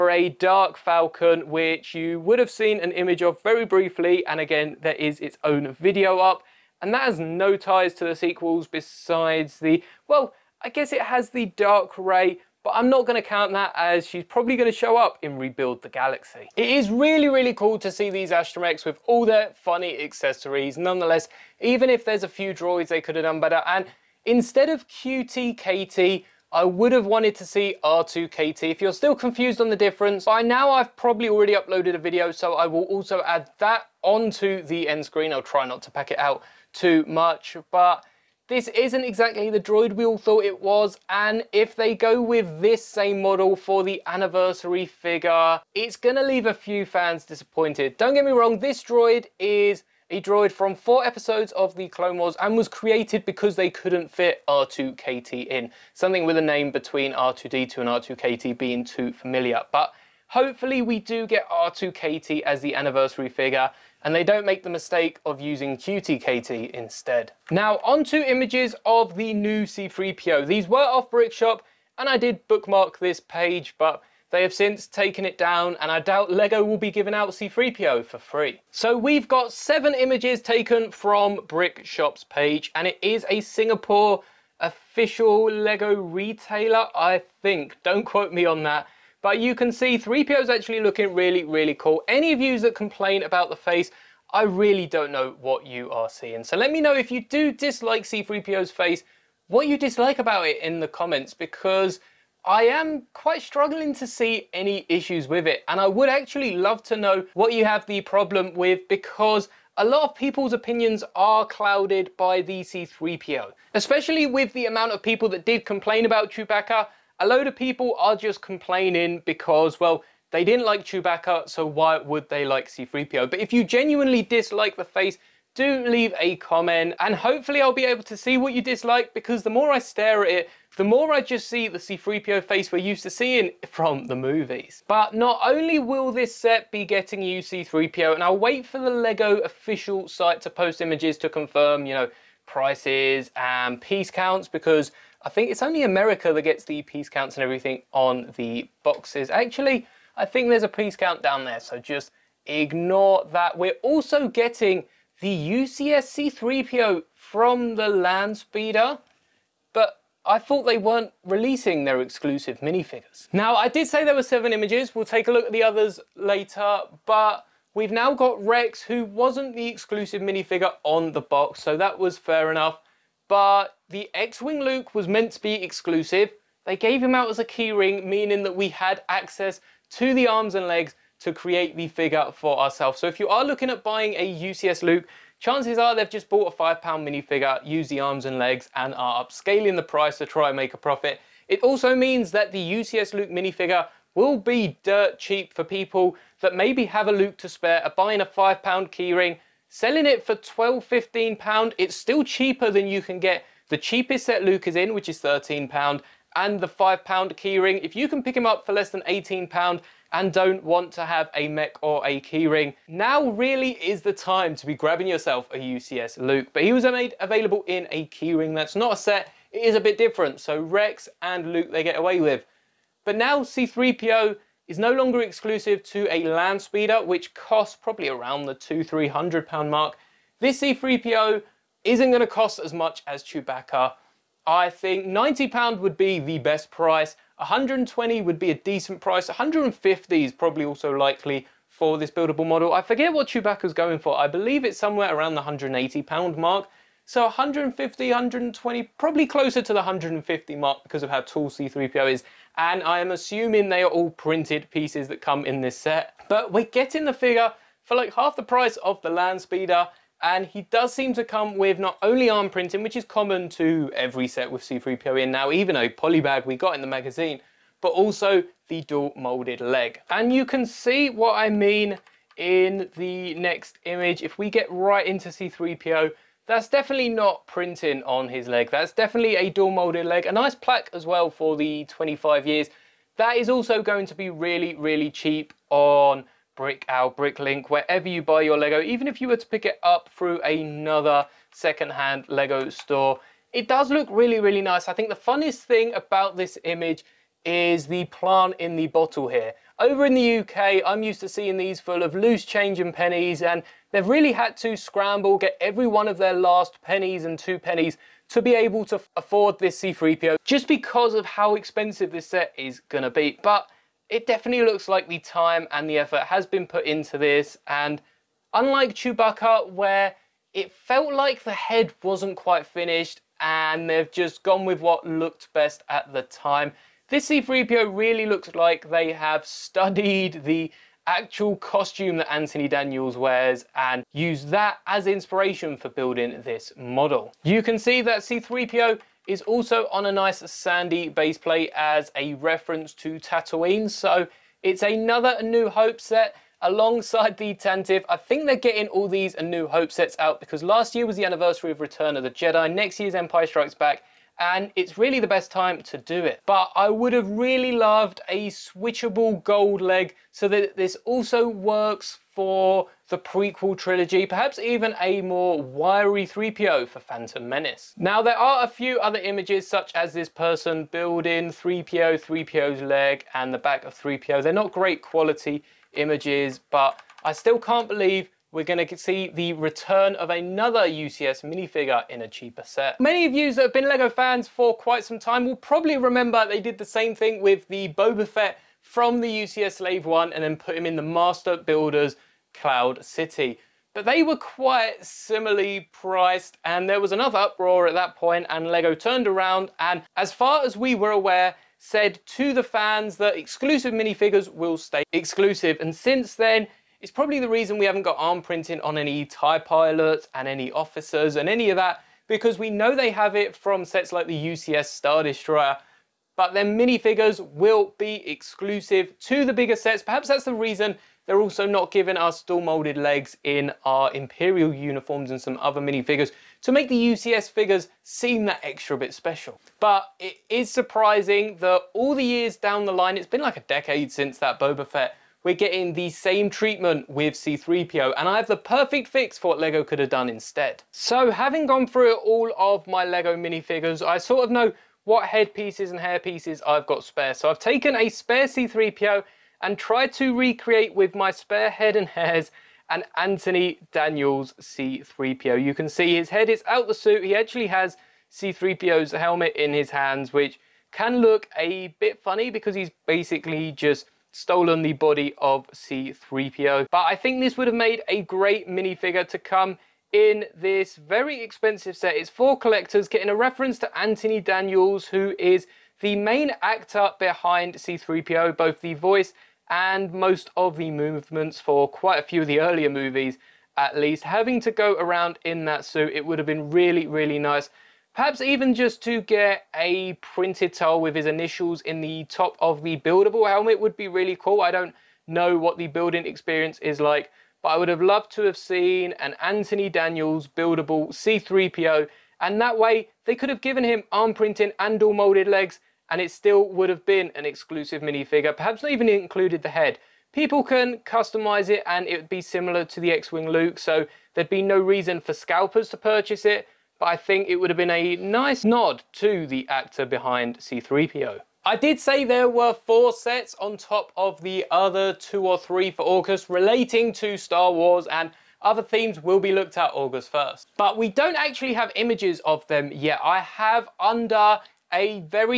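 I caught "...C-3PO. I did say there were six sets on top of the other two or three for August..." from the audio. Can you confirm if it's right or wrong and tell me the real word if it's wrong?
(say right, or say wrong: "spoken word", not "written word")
wrong: "four", not "six".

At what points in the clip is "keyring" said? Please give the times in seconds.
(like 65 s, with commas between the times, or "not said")
177 s, 198 s, 207 s, 212 s, 218 s.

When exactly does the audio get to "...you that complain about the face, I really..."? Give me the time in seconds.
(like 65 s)
92 s.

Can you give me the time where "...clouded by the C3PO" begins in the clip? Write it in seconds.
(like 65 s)
111 s.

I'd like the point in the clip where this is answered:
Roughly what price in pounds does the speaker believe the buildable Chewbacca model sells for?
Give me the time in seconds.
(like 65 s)
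245 s.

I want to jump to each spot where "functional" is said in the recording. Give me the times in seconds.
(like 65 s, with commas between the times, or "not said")
not said.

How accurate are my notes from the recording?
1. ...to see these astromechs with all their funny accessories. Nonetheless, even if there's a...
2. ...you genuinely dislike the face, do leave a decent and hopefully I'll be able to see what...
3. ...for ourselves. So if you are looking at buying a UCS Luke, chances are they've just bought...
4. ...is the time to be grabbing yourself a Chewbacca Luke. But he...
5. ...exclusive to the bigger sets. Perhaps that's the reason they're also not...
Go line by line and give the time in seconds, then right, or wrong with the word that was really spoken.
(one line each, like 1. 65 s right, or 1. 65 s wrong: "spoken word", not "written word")
1. 17 s right
2. 123 s wrong: "comment", not "decent"
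3. 182 s right
4. 213 s wrong: "UCS", not "Chewbacca"
5. 418 s right.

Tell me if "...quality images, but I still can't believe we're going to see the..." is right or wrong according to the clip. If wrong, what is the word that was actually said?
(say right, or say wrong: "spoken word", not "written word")
right.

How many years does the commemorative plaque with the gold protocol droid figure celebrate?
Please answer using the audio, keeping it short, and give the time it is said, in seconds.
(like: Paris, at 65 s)
25 years, at 281 s.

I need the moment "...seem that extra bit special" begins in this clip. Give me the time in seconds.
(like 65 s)
428 s.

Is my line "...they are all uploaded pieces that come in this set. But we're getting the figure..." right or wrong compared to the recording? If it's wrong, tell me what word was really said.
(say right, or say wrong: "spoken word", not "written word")
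wrong: "printed", not "uploaded".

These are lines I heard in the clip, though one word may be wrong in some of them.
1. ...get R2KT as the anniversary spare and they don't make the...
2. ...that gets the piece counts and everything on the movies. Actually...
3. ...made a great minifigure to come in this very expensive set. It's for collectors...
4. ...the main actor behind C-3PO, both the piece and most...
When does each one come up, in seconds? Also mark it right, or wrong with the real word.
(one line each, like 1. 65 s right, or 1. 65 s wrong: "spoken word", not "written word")
1. 61 s wrong: "figure", not "spare"
2. 146 s wrong: "boxes", not "movies"
3. 467 s right
4. 476 s wrong: "voice", not "piece".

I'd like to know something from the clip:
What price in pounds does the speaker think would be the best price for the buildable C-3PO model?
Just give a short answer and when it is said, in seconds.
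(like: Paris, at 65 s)
£90, at 235 s.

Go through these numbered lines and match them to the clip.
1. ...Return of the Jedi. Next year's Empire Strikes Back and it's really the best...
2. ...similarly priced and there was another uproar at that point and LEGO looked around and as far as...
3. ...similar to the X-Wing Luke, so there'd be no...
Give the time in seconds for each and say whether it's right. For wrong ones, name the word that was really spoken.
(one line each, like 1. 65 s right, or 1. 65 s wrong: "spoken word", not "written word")
1. 351 s right
2. 395 s wrong: "turned", not "looked"
3. 512 s right.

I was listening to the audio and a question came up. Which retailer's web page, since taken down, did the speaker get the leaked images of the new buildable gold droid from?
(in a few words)
Brickshop.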